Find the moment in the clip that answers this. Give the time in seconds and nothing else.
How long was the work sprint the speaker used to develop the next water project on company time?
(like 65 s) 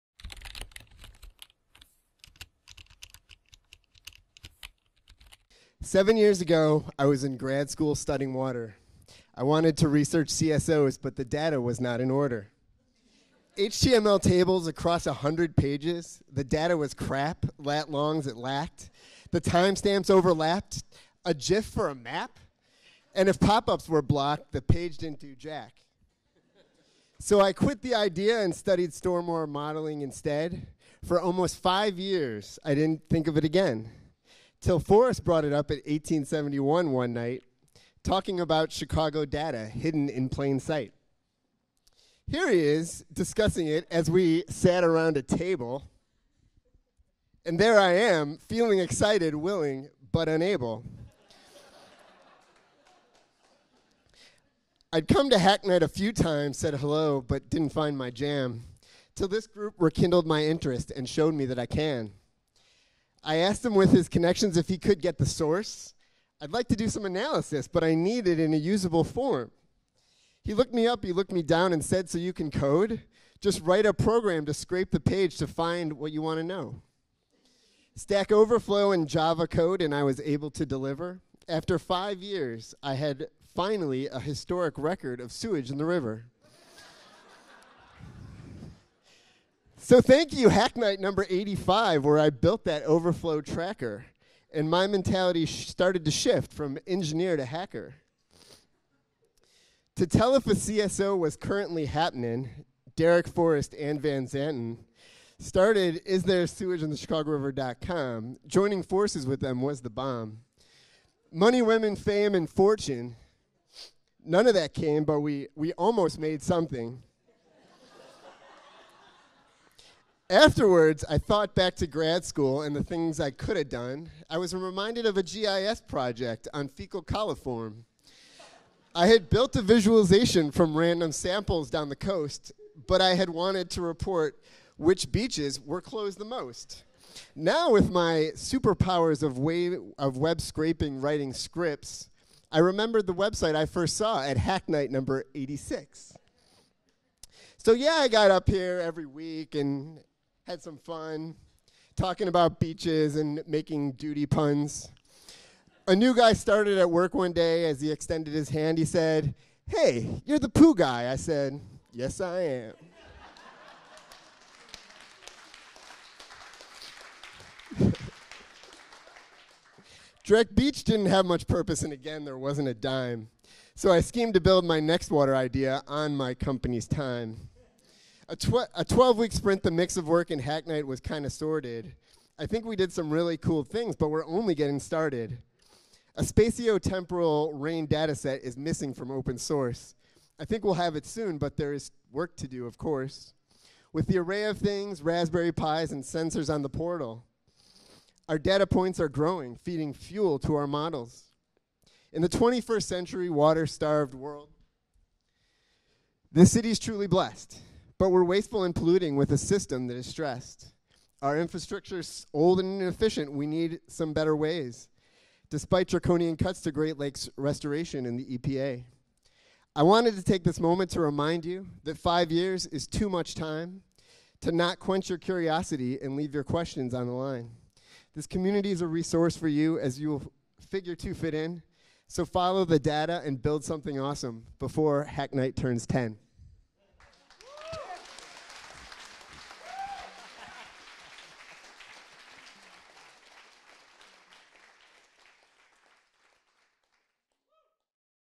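178 s.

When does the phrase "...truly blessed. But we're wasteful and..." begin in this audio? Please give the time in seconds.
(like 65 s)
206 s.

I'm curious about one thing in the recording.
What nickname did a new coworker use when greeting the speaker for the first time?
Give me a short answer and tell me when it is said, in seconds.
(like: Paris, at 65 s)
the poo guy, at 160 s.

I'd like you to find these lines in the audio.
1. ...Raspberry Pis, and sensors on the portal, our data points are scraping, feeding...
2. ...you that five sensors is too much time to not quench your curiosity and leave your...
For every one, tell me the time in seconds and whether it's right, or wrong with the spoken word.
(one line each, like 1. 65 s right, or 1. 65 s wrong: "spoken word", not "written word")
1. 195 s wrong: "growing", not "scraping"
2. 221 s wrong: "years", not "sensors".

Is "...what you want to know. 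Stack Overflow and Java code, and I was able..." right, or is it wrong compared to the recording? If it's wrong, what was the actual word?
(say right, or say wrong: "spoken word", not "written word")
right.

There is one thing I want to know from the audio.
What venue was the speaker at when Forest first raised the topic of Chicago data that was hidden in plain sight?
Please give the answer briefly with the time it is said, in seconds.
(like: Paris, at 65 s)
1871, at 35 s.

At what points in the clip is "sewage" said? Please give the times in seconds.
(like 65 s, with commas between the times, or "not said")
85 s, 106 s.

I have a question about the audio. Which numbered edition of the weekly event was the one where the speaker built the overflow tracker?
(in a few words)
85.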